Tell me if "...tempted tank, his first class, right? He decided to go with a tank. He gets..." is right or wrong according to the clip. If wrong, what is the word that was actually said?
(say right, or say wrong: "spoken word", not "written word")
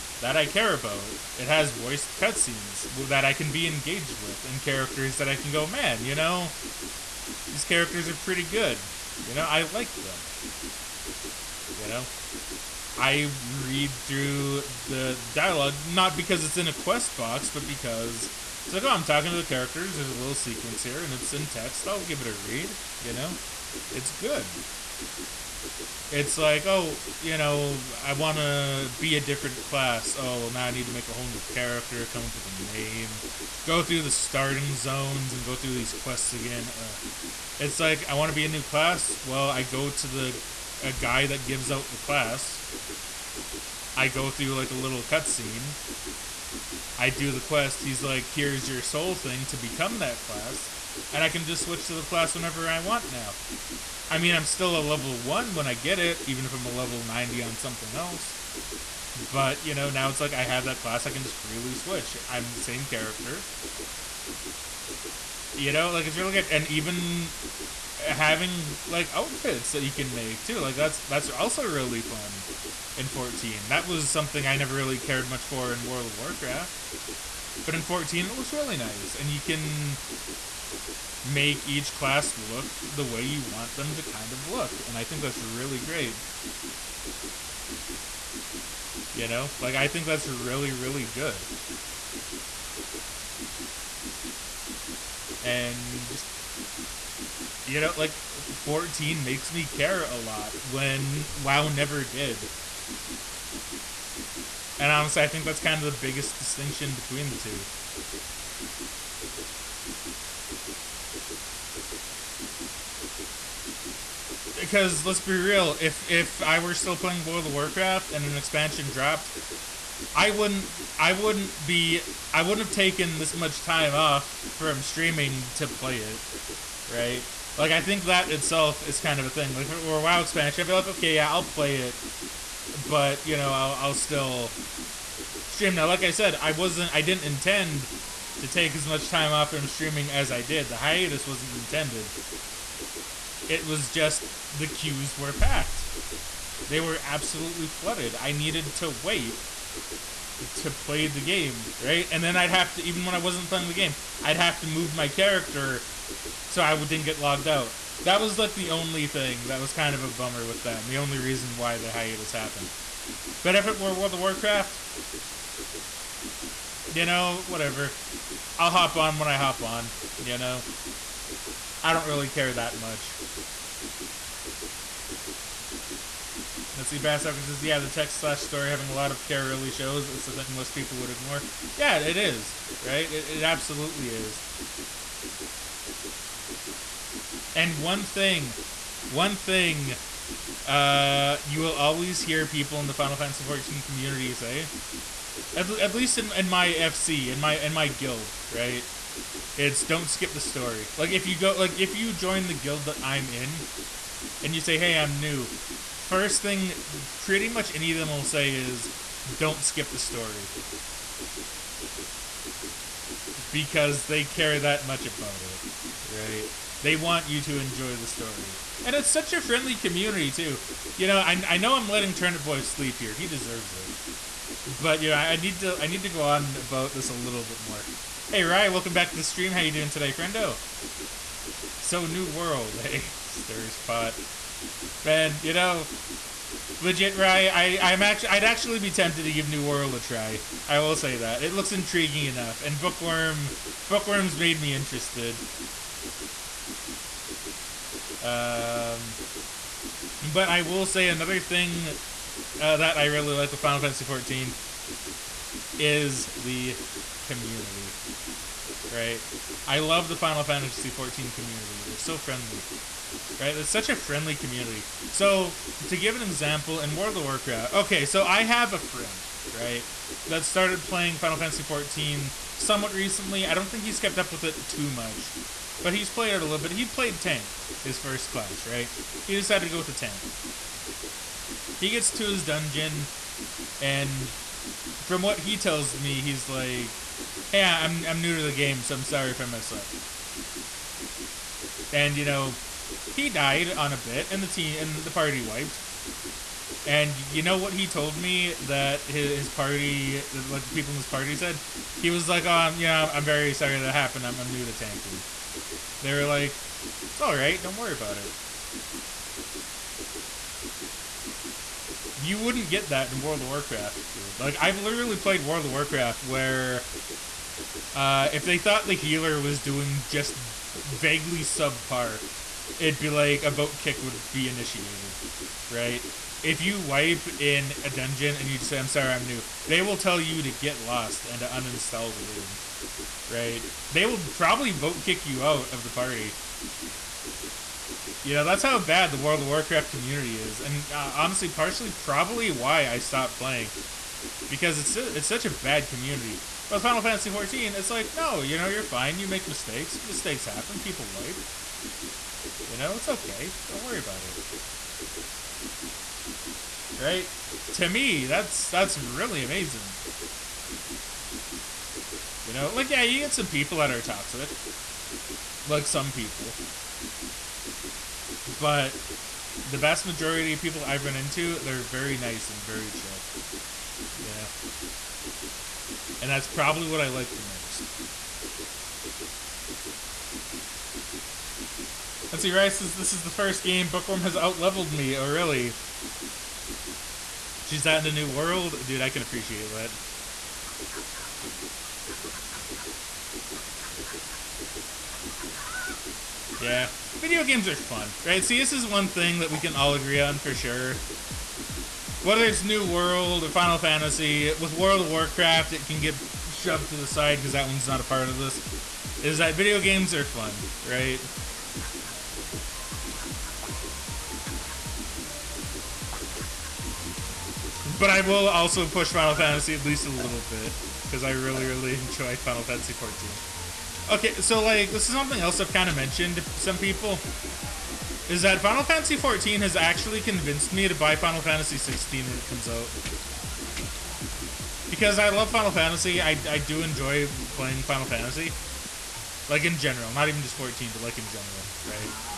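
wrong: "played", not "tempted".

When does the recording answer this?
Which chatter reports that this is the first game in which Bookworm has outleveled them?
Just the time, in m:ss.
6:22.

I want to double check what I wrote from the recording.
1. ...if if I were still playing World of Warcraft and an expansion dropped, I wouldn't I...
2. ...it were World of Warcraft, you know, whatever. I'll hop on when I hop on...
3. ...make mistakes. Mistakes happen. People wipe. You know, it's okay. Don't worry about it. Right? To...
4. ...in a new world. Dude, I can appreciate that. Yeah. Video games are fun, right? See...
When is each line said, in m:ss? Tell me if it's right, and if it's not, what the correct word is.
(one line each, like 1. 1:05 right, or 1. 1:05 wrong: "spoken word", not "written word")
1. 1:55 right
2. 2:43 right
3. 5:49 right
4. 6:27 right.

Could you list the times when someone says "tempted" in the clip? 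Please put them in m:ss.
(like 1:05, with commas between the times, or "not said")
3:58.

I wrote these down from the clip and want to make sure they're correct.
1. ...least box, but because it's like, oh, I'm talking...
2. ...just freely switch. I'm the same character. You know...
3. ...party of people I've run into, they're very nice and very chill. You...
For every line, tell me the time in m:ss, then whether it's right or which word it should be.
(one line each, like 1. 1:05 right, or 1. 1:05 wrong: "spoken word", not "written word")
1. 0:16 wrong: "quest", not "least"
2. 1:01 right
3. 6:10 wrong: "majority", not "party".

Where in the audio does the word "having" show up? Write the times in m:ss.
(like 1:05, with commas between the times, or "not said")
1:07, 2:58.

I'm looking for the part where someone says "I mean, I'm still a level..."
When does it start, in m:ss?
0:54.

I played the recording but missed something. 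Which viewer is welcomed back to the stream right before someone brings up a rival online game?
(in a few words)
Ryan.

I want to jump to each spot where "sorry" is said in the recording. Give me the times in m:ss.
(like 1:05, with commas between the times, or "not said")
4:49, 5:03, 5:28.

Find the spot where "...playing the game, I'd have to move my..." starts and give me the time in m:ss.
2:33.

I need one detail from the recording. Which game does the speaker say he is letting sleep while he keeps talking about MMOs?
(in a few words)
Turnip Boy.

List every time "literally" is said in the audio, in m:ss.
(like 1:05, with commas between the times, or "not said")
5:14.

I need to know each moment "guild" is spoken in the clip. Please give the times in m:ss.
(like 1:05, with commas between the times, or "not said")
3:17, 3:22.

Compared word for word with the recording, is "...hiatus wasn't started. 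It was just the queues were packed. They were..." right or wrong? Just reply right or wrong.
wrong.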